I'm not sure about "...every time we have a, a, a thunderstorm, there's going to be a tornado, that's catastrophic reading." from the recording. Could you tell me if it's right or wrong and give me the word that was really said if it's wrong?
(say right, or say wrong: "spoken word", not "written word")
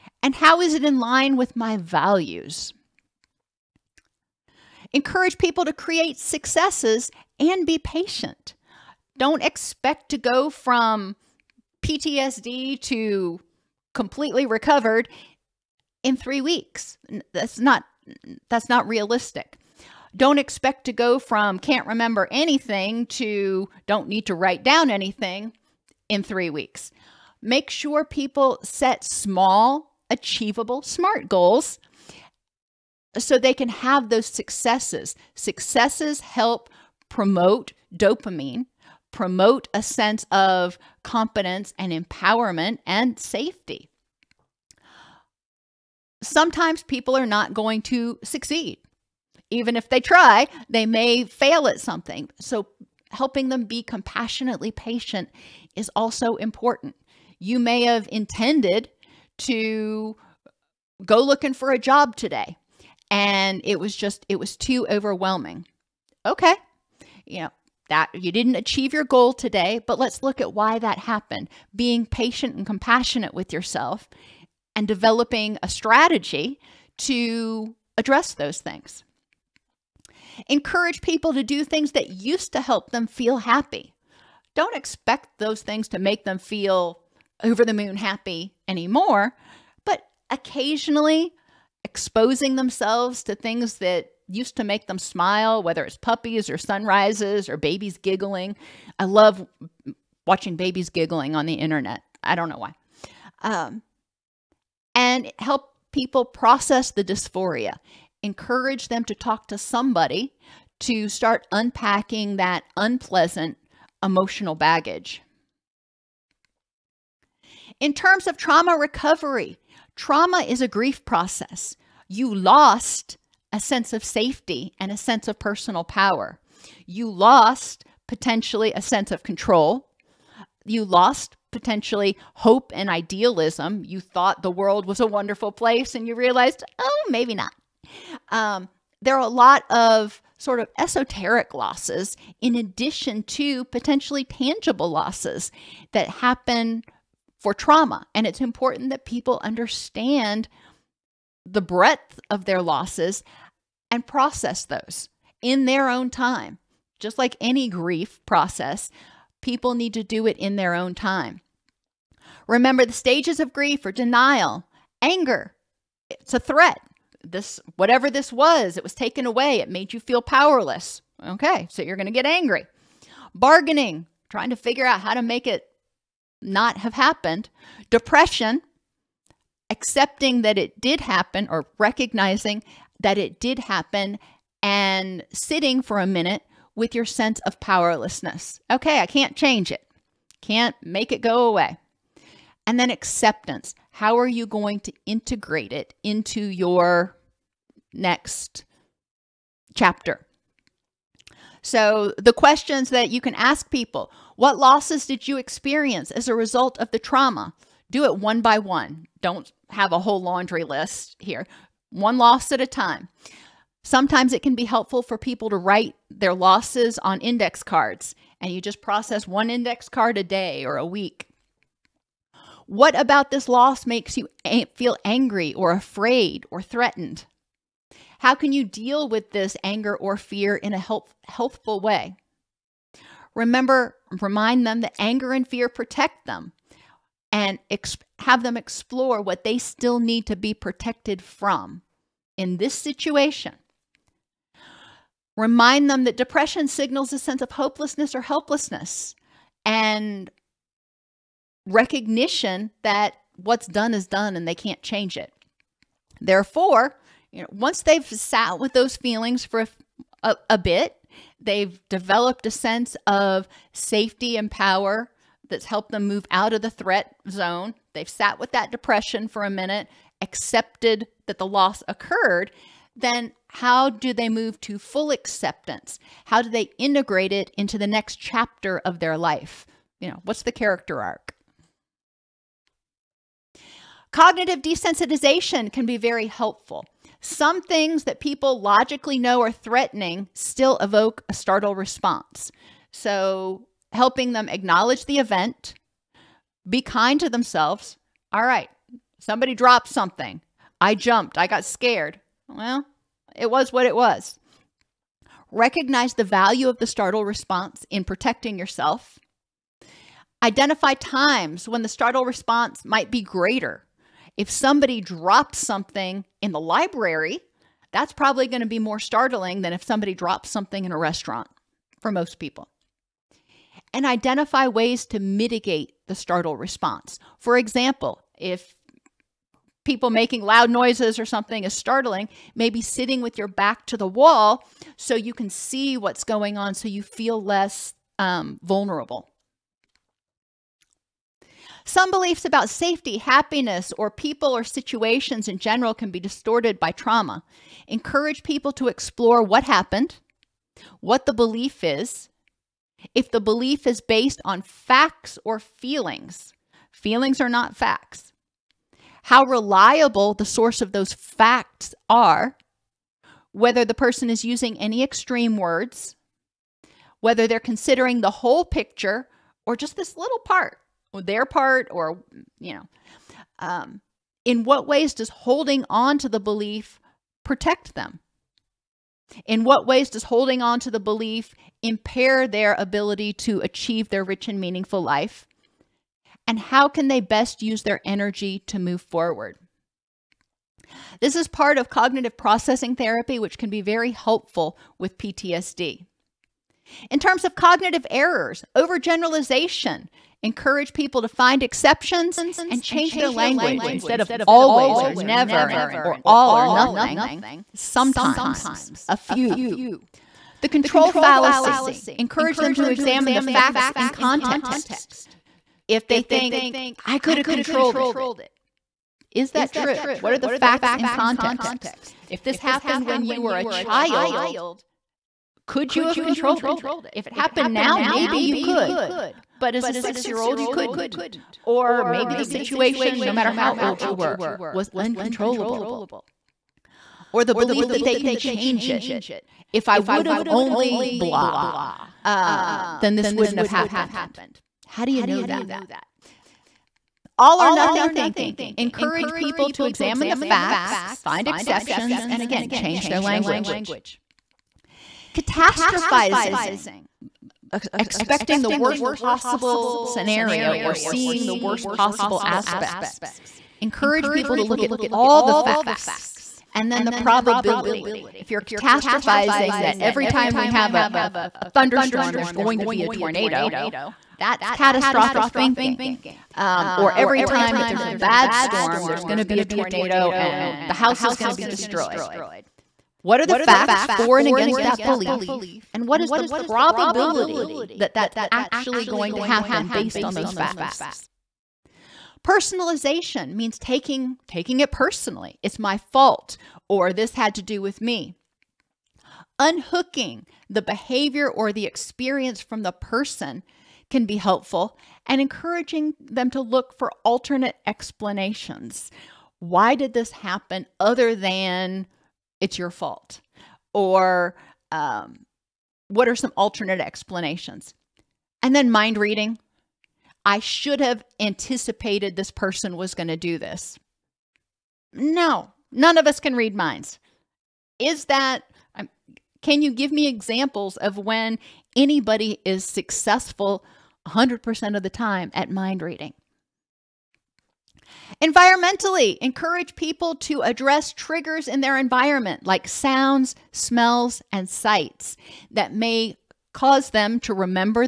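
wrong: "thinking", not "reading".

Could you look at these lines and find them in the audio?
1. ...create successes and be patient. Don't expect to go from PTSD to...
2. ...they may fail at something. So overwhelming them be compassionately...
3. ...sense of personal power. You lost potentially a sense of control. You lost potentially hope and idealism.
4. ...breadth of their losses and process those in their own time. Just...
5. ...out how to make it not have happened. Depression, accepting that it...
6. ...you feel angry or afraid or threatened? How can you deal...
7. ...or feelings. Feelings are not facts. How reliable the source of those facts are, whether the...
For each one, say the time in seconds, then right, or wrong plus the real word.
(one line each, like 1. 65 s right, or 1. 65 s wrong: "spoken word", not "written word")
1. 5 s right
2. 50 s wrong: "helping", not "overwhelming"
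3. 124 s right
4. 151 s right
5. 174 s right
6. 224 s right
7. 355 s right.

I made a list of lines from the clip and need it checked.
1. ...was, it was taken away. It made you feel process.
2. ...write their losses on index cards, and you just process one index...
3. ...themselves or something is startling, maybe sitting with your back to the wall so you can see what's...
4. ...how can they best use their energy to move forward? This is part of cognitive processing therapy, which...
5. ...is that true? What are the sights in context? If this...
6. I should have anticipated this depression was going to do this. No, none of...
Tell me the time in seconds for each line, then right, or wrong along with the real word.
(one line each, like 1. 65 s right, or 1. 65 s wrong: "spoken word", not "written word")
1. 168 s wrong: "powerless", not "process"
2. 215 s right
3. 330 s wrong: "noises", not "themselves"
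4. 386 s right
5. 419 s wrong: "facts", not "sights"
6. 520 s wrong: "person", not "depression".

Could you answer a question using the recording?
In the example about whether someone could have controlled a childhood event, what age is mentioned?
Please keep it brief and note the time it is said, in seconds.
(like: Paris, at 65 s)
6, at 429 s.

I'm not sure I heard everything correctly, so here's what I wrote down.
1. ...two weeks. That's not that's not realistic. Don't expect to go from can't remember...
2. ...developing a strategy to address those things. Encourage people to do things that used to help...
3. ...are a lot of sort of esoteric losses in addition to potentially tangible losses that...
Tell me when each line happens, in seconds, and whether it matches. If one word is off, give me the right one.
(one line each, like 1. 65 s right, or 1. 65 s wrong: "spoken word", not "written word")
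1. 16 s wrong: "three", not "two"
2. 74 s right
3. 139 s right.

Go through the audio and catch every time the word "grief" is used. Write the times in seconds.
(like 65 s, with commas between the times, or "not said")
120 s, 157 s, 163 s.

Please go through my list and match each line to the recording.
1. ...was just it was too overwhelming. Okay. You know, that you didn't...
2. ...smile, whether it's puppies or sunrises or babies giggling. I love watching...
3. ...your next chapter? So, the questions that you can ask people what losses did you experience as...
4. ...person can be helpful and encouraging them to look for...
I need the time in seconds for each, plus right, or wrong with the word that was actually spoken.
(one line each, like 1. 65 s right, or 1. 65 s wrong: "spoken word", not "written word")
1. 63 s right
2. 94 s right
3. 196 s right
4. 502 s right.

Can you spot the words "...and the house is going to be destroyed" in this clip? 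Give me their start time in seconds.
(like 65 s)
480 s.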